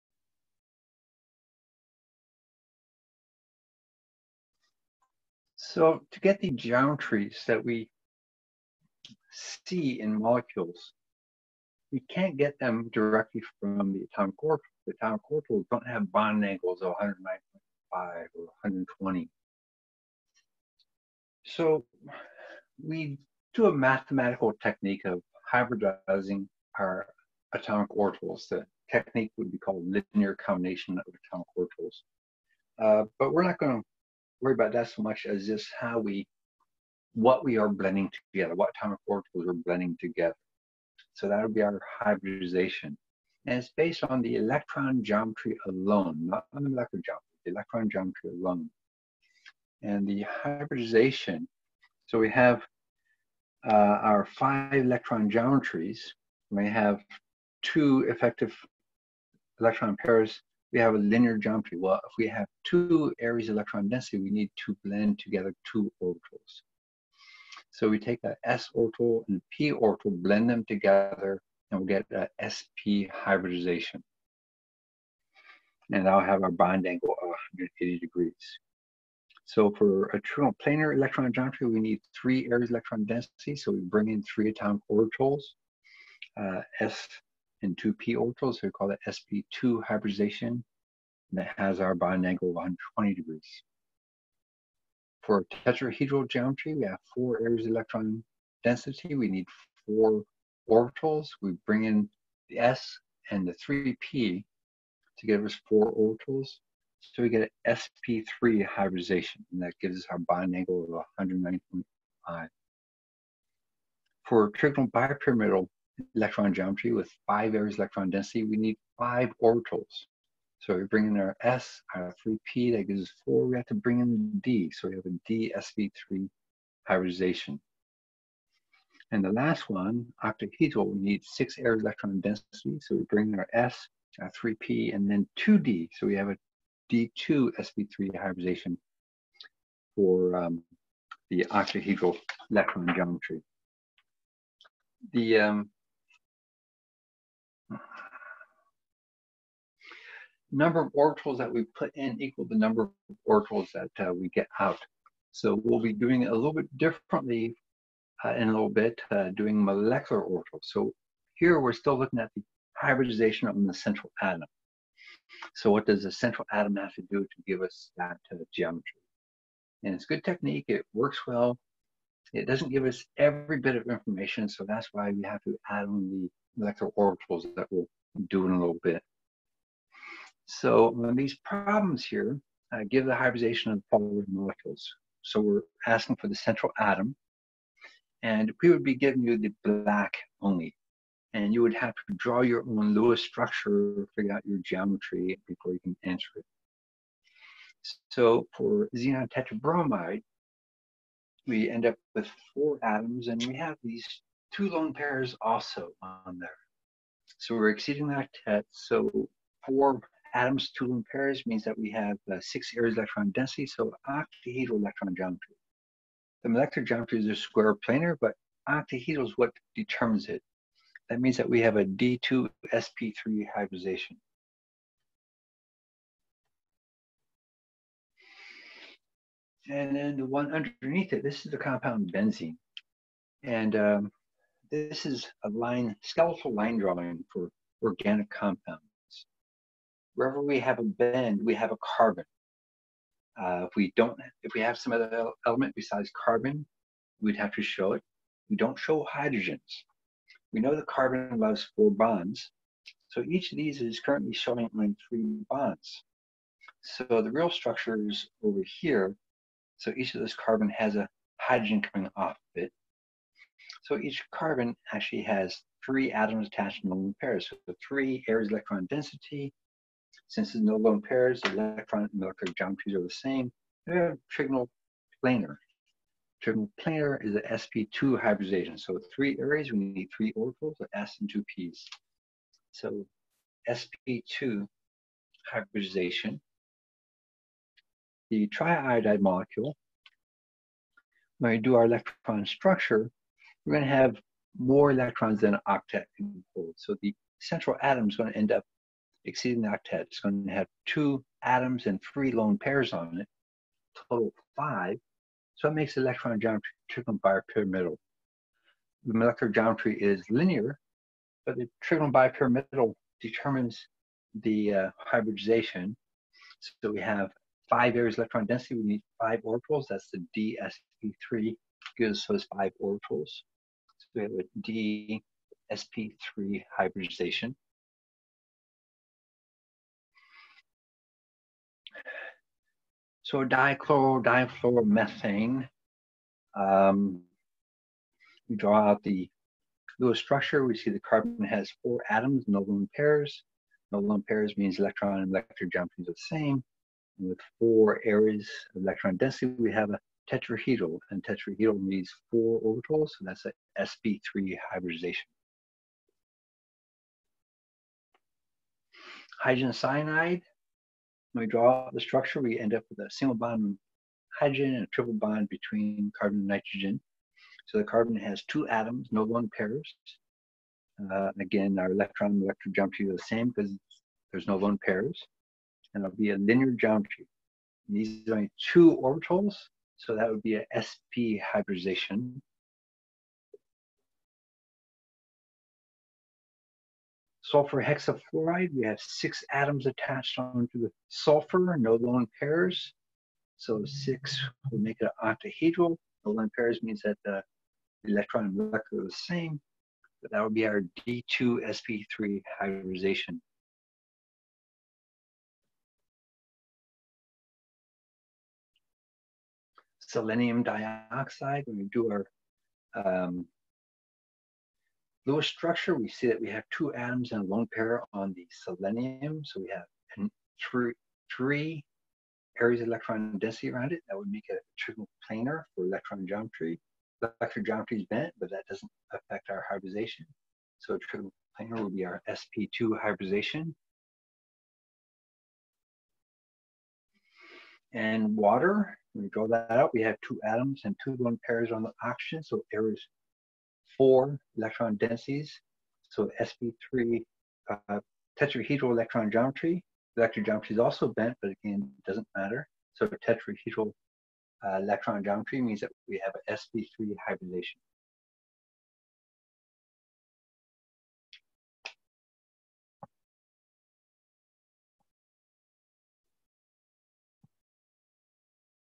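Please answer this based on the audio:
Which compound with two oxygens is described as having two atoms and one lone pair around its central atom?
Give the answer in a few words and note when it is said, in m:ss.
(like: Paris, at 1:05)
selenium dioxide, at 6:49.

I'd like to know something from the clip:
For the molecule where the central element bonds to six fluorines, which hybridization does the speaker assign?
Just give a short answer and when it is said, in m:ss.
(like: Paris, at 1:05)
d2sp3, at 6:41.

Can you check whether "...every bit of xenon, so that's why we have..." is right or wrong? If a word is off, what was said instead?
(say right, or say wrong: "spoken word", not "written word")
wrong: "information", not "xenon".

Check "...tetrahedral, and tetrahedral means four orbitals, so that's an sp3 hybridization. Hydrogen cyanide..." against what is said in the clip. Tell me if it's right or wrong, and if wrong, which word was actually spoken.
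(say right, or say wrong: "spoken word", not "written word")
right.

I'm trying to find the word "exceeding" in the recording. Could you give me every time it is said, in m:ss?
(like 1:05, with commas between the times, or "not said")
3:27, 4:59.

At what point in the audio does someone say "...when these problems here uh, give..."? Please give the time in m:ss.
3:00.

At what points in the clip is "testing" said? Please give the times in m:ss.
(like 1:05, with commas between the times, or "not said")
not said.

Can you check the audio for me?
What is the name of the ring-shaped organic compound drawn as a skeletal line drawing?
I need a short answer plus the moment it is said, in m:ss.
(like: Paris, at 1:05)
benzene, at 3:52.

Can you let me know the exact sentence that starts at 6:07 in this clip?
So the carbon has two atoms, no lone pairs.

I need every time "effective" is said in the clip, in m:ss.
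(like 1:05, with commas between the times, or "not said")
0:58.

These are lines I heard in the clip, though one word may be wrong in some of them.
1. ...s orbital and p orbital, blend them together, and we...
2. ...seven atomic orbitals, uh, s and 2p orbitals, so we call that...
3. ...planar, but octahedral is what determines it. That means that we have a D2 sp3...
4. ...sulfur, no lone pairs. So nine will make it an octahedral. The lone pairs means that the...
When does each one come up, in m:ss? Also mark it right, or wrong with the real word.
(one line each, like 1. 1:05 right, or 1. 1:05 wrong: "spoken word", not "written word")
1. 1:08 right
2. 1:24 wrong: "three", not "seven"
3. 3:37 right
4. 6:31 wrong: "six", not "nine".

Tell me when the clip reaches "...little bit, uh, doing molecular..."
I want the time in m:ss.
2:38.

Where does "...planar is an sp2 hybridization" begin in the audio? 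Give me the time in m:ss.
4:36.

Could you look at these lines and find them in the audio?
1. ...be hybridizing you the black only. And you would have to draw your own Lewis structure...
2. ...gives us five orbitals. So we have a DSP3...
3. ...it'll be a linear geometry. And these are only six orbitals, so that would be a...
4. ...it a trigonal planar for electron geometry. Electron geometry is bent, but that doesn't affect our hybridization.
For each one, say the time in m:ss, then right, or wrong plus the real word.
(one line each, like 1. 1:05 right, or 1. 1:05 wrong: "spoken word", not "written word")
1. 3:08 wrong: "giving", not "hybridizing"
2. 5:21 right
3. 6:16 wrong: "two", not "six"
4. 7:04 right.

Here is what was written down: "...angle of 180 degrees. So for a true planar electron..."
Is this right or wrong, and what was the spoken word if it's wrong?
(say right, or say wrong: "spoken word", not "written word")
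right.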